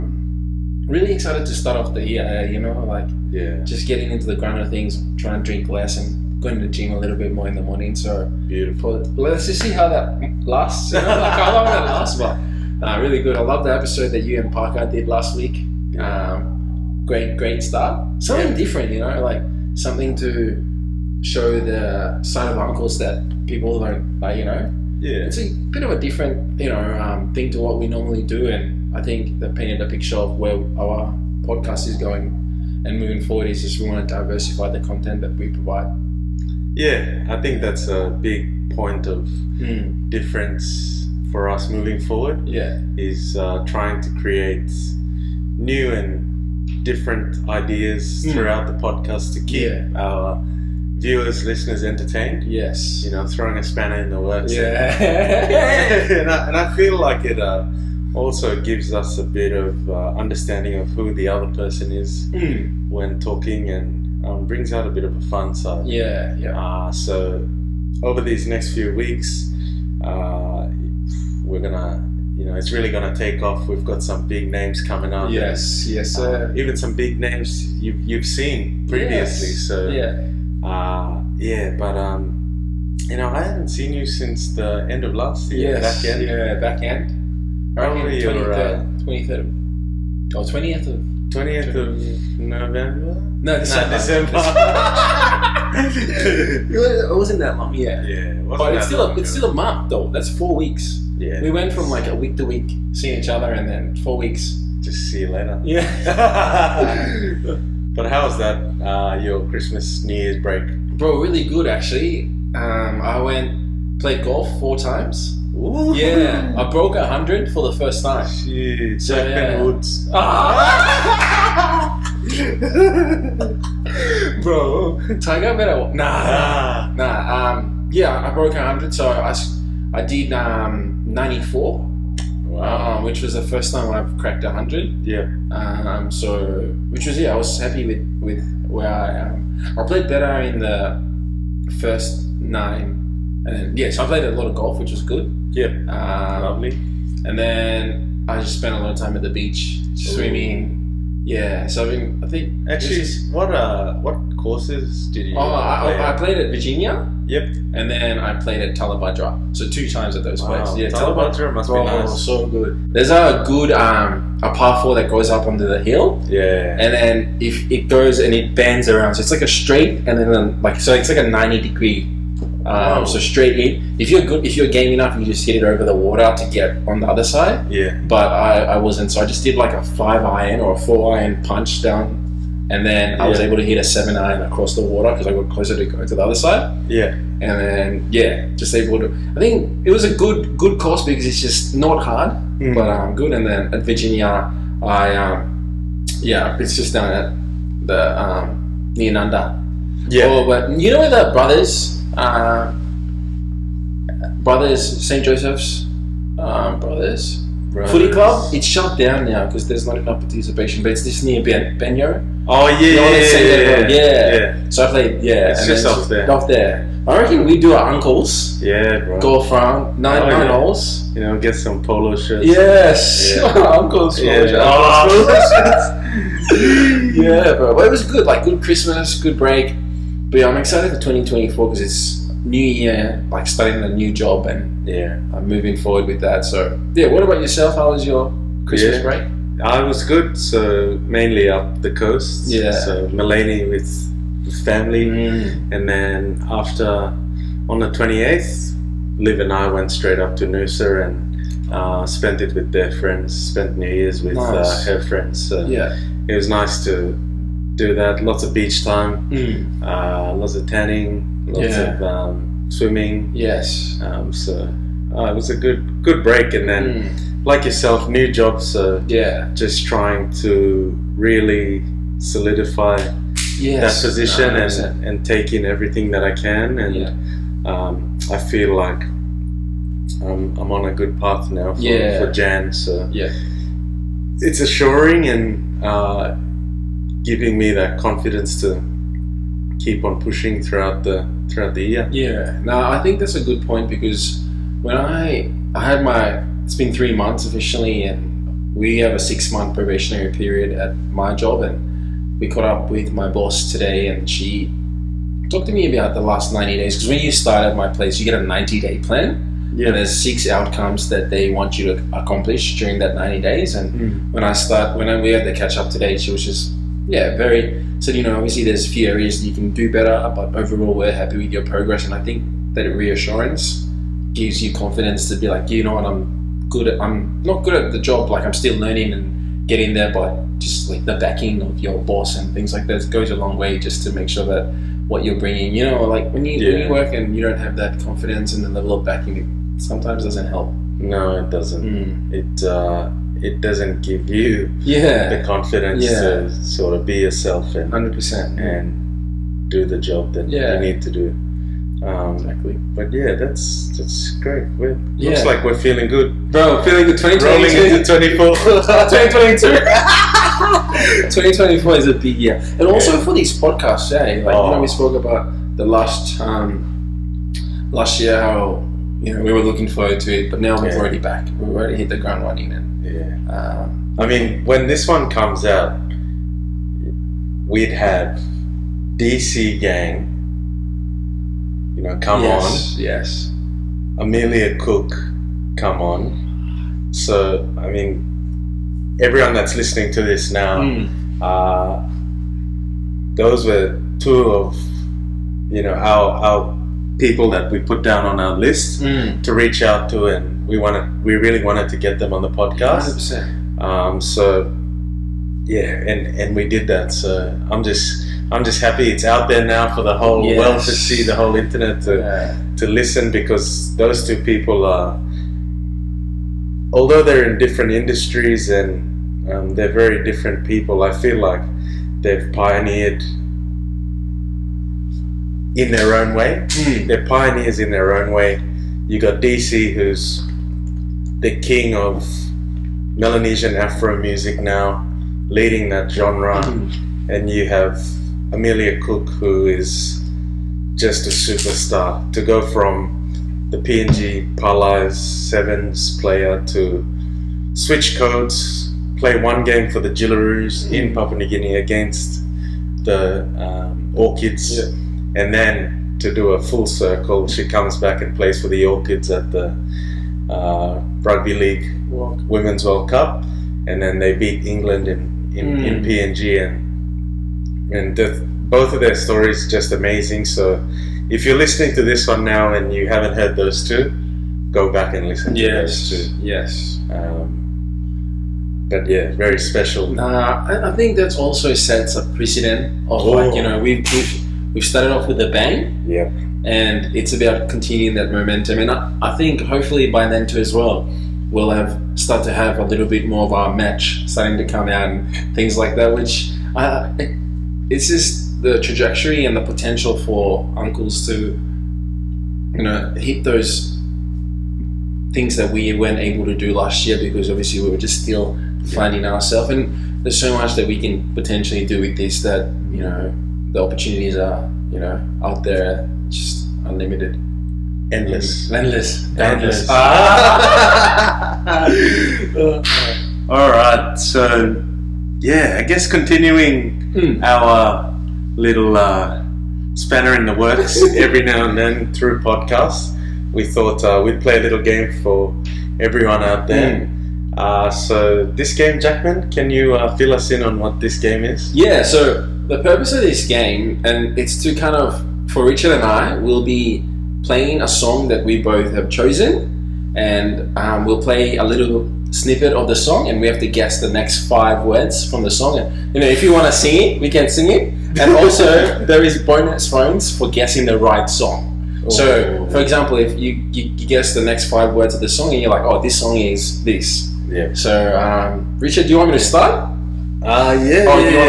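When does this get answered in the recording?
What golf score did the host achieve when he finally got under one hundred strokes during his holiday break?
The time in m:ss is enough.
2:11.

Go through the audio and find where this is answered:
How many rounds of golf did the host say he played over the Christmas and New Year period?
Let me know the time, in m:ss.
1:54.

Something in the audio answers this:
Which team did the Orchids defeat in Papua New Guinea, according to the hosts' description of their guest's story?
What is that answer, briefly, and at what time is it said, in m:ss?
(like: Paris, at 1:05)
England, at 7:44.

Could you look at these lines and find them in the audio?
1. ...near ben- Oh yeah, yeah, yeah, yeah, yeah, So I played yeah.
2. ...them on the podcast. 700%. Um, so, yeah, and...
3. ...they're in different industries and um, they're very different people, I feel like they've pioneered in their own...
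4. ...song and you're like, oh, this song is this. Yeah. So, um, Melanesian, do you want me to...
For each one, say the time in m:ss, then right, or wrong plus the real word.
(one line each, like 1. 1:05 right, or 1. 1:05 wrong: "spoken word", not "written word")
1. 3:31 right
2. 6:42 wrong: "100", not "700"
3. 6:57 right
4. 9:25 wrong: "Richard", not "Melanesian".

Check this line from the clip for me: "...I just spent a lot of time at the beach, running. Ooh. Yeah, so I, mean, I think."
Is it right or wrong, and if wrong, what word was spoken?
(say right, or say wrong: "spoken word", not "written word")
wrong: "swimming", not "running".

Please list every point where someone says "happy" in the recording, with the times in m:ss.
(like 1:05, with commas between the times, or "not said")
2:17, 5:21, 6:48.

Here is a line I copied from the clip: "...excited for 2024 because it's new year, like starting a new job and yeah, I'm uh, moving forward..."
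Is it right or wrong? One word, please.
right.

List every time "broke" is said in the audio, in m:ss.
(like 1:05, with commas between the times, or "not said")
1:56, 2:08.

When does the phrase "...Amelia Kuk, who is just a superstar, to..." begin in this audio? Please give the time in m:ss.
7:18.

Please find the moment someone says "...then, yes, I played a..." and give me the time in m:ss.
2:23.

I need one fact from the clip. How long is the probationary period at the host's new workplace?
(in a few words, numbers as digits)
6 months.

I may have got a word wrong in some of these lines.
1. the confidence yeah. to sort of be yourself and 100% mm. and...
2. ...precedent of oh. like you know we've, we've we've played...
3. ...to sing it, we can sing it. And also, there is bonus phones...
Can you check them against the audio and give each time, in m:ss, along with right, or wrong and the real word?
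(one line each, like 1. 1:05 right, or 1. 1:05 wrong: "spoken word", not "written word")
1. 5:45 right
2. 8:02 wrong: "started", not "played"
3. 9:16 right.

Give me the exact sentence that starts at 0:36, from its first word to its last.
Yeah, I think that's a big point of mm.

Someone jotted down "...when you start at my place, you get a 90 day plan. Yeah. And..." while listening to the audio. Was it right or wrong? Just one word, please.
right.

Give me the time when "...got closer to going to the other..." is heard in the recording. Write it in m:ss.
3:05.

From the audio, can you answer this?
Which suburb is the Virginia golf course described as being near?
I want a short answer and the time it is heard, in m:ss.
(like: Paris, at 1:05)
Nundah, at 3:19.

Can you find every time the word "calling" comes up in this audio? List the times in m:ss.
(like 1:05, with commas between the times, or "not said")
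not said.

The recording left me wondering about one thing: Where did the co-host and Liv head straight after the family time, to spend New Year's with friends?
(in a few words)
Noosa.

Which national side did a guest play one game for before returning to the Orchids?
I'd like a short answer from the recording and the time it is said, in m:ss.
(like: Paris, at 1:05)
Jillaroos, at 7:30.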